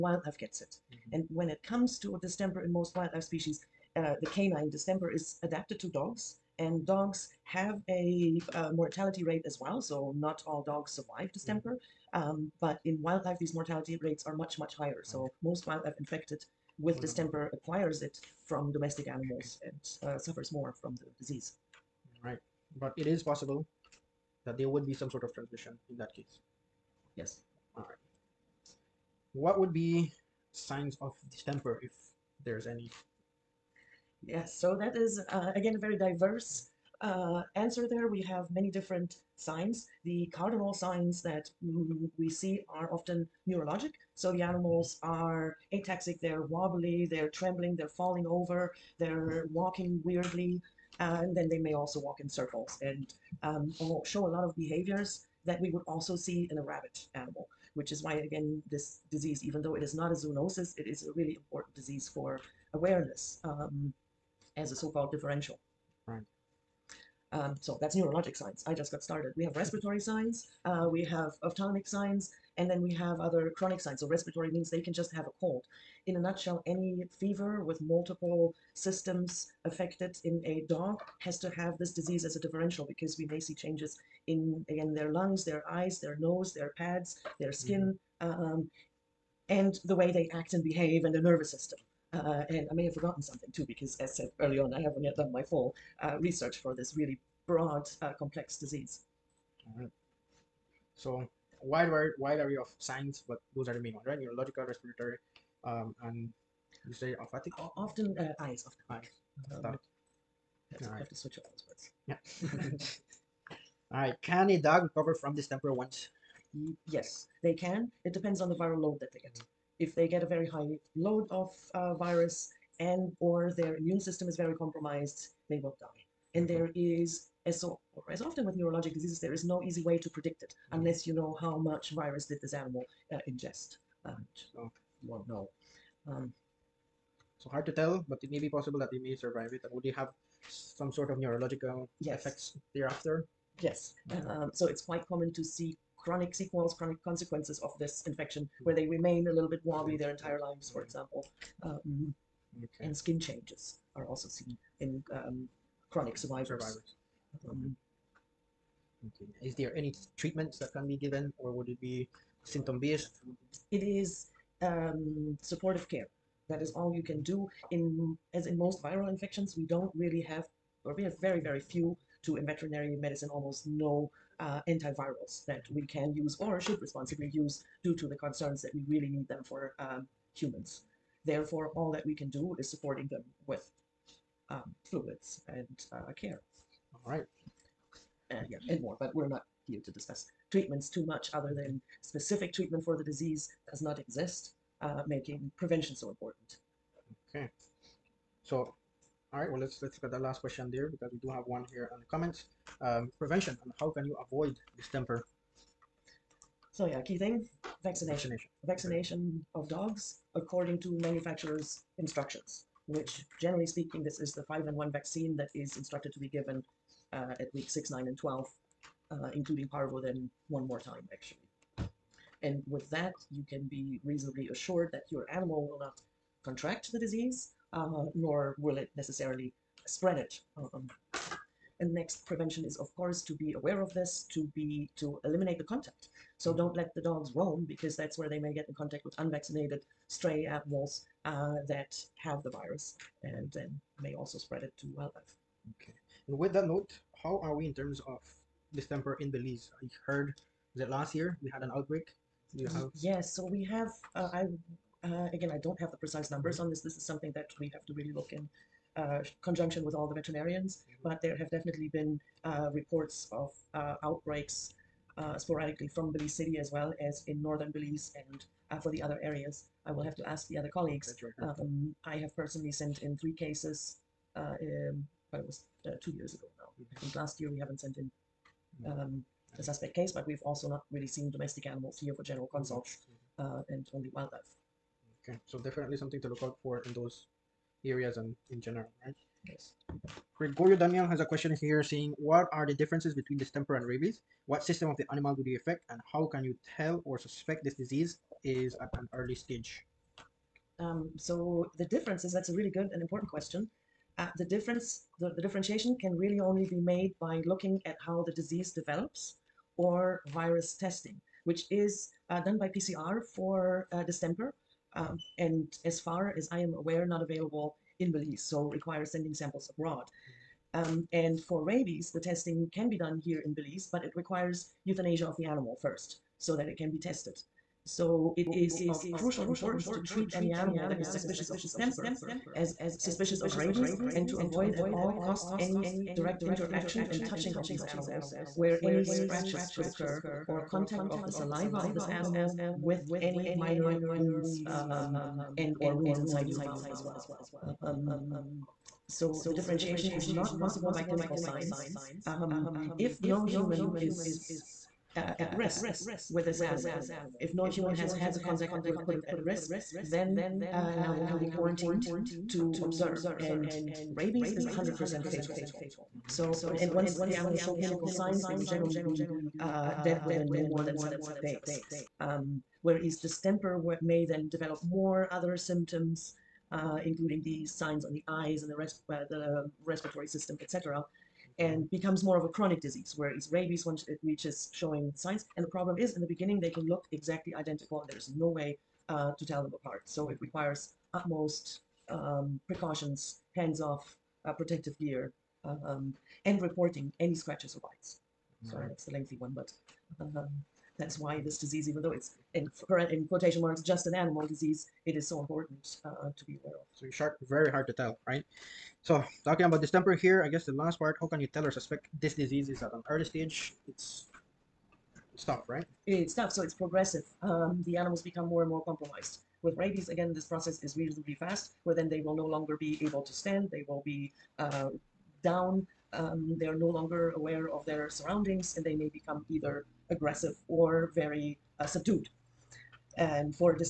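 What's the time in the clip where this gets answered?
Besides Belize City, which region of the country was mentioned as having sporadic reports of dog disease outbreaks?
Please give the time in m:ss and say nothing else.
4:27.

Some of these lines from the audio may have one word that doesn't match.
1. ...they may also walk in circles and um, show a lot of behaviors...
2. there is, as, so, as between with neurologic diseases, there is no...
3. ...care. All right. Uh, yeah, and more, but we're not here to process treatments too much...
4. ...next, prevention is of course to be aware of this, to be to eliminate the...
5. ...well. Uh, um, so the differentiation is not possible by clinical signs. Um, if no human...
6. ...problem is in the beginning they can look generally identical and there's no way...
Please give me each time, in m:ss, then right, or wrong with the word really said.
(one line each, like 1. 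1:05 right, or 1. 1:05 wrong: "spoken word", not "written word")
1. 0:51 right
2. 2:06 wrong: "often", not "between"
3. 3:06 wrong: "discuss", not "process"
4. 3:51 right
5. 5:47 right
6. 6:25 wrong: "exactly", not "generally".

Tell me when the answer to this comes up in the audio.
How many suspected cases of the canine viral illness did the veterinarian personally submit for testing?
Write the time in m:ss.
4:33.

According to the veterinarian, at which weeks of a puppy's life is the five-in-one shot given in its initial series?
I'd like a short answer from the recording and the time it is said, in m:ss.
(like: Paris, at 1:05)
6, 9 and 12, at 3:37.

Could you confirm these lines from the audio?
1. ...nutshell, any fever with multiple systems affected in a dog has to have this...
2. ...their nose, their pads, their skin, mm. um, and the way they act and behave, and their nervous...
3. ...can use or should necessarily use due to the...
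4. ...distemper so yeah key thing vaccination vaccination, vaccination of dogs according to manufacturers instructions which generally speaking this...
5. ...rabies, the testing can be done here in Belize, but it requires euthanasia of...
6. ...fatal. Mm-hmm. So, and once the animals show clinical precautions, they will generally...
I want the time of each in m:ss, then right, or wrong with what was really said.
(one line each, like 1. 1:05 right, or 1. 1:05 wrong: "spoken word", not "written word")
1. 1:16 right
2. 1:25 right
3. 2:55 wrong: "responsibly", not "necessarily"
4. 3:24 right
5. 5:21 right
6. 6:05 wrong: "signs", not "precautions".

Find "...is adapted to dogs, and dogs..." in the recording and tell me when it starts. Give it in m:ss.
0:05.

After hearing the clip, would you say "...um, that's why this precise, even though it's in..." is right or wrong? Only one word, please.
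wrong.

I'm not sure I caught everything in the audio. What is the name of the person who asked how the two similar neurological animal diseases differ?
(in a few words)
Gregorio Daniel.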